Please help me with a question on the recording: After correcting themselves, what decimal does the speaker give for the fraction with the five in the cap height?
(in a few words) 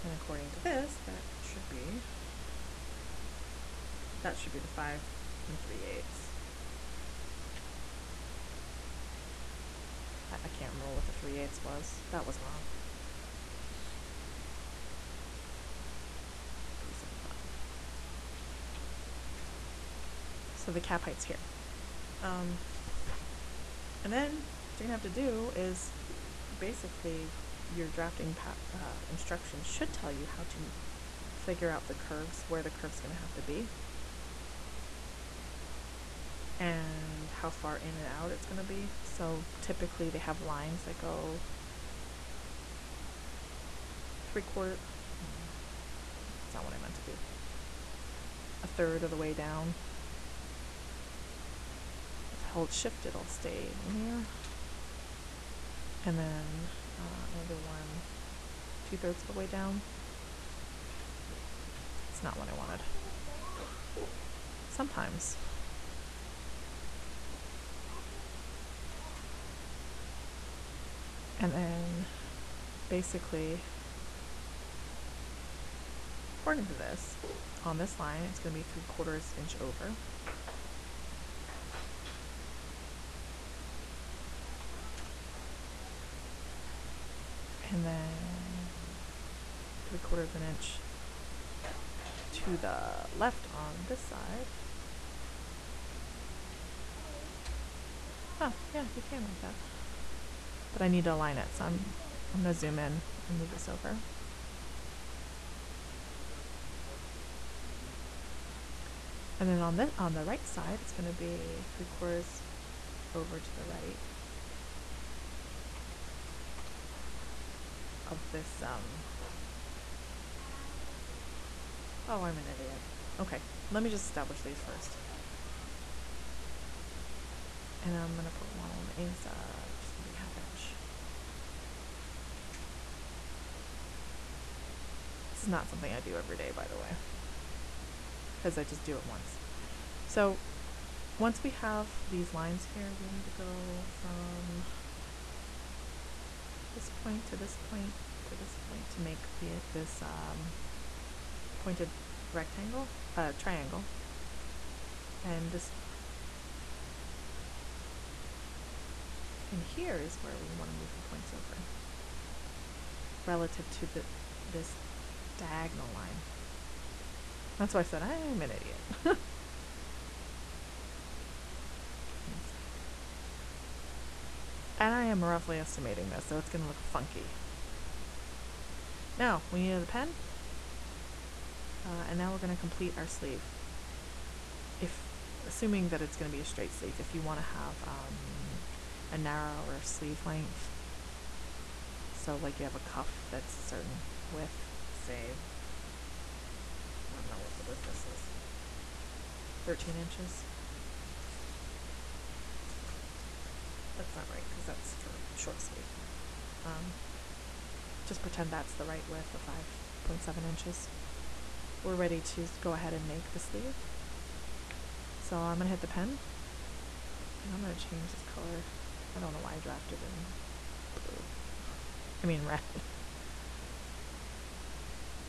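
375.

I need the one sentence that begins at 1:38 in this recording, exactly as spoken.
Oh, yeah, you can write that.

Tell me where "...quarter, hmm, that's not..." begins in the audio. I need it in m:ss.
0:44.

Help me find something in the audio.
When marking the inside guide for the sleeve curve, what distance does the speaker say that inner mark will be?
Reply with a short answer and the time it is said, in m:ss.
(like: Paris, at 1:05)
half inch, at 2:10.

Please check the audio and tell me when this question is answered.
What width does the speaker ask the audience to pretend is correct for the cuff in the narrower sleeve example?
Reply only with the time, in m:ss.
3:29.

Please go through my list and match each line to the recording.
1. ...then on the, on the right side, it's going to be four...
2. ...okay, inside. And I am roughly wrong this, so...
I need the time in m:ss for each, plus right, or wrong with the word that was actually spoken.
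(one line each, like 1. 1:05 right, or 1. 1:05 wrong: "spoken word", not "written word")
1. 1:49 wrong: "three", not "four"
2. 2:49 wrong: "estimating", not "wrong".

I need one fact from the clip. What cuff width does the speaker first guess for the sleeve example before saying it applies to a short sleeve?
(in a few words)
13 inches.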